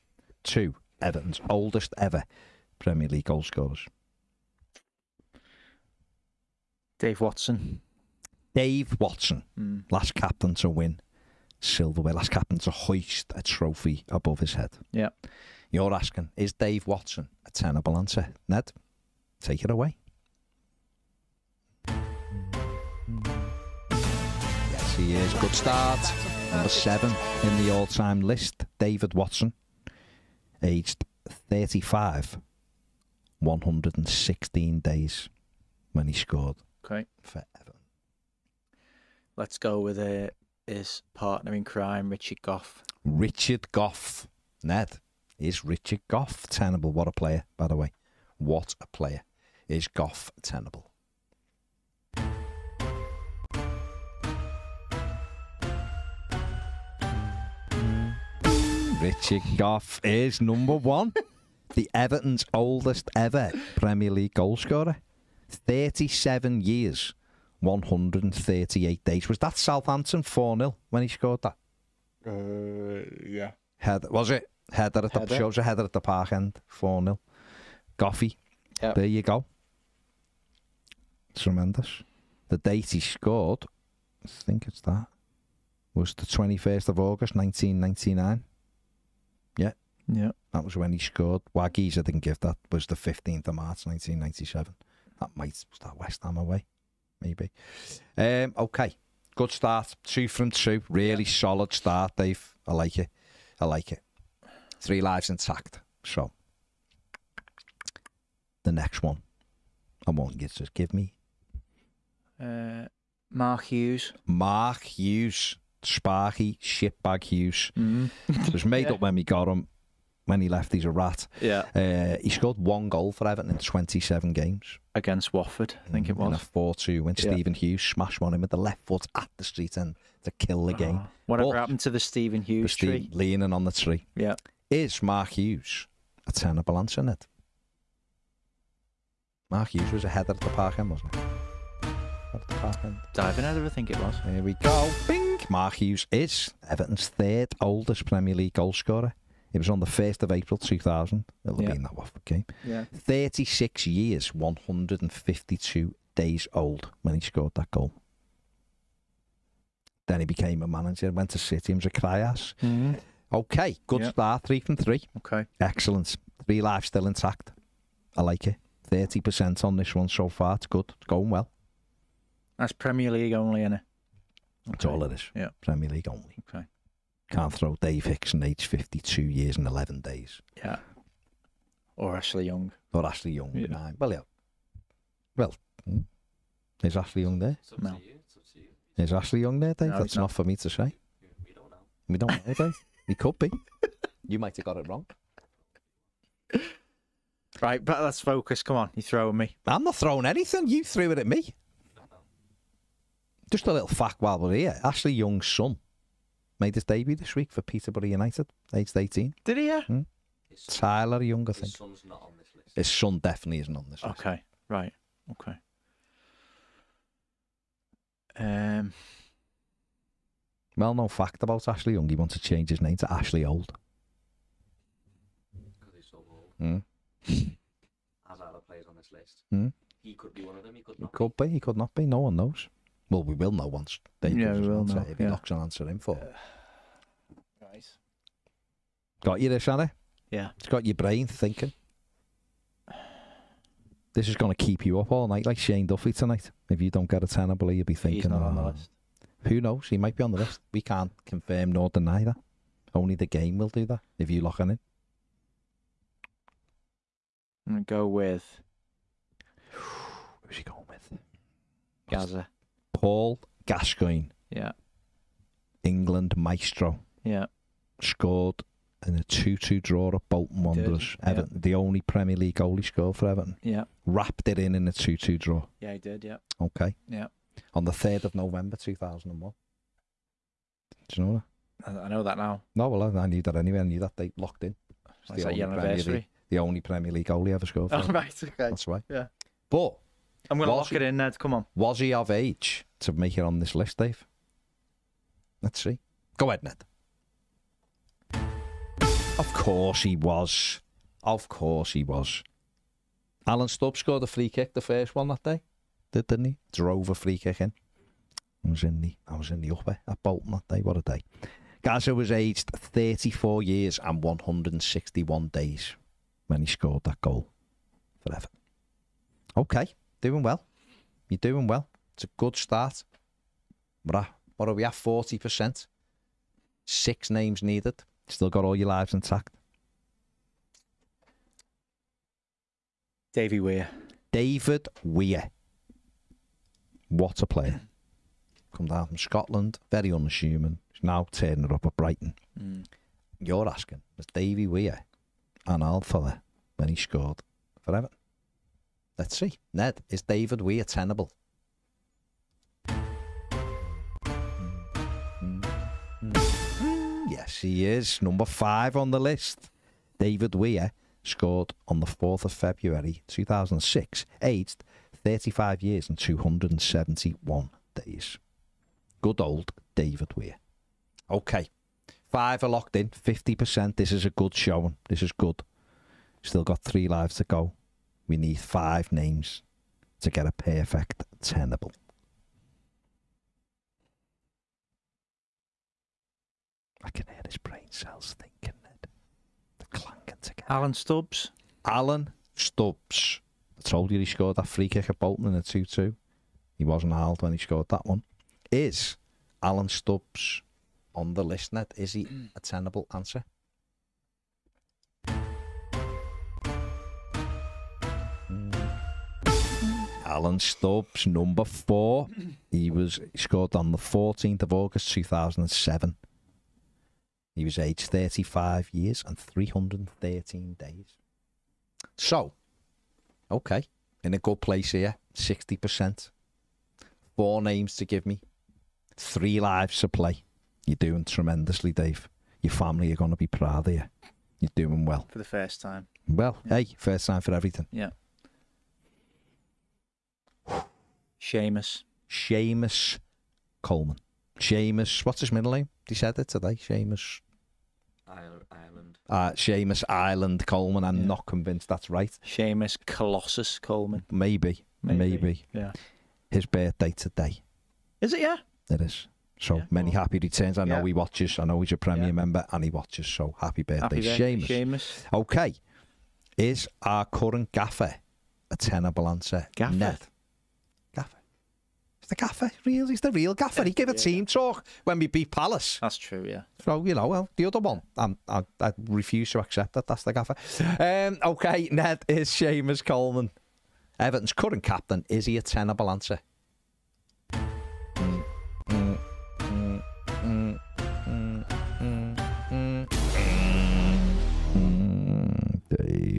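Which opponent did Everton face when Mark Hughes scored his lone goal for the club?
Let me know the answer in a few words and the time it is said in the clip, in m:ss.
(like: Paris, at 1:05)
Watford, at 2:05.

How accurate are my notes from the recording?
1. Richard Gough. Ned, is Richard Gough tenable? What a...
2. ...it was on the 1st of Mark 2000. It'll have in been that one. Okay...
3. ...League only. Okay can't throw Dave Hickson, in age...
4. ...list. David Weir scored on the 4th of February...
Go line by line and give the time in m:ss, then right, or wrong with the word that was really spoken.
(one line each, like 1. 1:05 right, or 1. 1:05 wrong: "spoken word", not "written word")
1. 0:43 right
2. 2:29 wrong: "April", not "Mark"
3. 2:55 right
4. 5:59 right.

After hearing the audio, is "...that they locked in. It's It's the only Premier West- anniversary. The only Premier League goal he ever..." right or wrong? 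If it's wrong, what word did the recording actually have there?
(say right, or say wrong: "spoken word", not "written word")
wrong: "League", not "West".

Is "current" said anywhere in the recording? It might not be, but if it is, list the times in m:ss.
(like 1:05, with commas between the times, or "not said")
7:47, 8:04.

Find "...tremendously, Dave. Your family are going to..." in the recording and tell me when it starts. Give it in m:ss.
7:11.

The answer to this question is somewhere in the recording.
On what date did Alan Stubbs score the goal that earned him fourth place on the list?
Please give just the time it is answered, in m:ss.
6:53.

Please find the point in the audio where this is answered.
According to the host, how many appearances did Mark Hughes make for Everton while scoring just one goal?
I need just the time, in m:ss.
2:03.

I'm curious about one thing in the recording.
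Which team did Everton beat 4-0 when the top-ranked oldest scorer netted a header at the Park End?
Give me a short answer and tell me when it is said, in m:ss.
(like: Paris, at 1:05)
Southampton, at 1:09.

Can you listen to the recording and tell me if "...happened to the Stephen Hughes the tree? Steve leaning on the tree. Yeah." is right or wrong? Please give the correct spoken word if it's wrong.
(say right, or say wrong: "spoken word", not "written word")
right.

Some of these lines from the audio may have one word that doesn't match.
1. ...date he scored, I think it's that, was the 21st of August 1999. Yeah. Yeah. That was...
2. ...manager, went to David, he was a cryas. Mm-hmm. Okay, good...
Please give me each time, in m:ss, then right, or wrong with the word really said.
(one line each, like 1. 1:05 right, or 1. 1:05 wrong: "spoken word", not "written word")
1. 1:22 right
2. 2:40 wrong: "City", not "David".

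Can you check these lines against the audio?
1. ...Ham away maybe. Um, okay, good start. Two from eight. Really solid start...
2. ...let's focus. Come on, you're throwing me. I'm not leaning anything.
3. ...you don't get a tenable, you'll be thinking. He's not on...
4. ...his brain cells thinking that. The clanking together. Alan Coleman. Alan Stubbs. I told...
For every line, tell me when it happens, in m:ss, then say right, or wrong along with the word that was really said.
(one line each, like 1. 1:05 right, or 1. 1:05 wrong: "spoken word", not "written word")
1. 1:36 wrong: "two", not "eight"
2. 3:18 wrong: "throwing", not "leaning"
3. 4:06 right
4. 6:27 wrong: "Stubbs", not "Coleman".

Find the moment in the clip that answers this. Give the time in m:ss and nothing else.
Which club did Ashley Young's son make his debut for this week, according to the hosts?
3:27.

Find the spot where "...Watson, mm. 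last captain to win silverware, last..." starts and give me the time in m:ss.
0:08.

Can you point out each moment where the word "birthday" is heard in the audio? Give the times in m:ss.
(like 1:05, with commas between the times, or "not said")
7:36, 7:43.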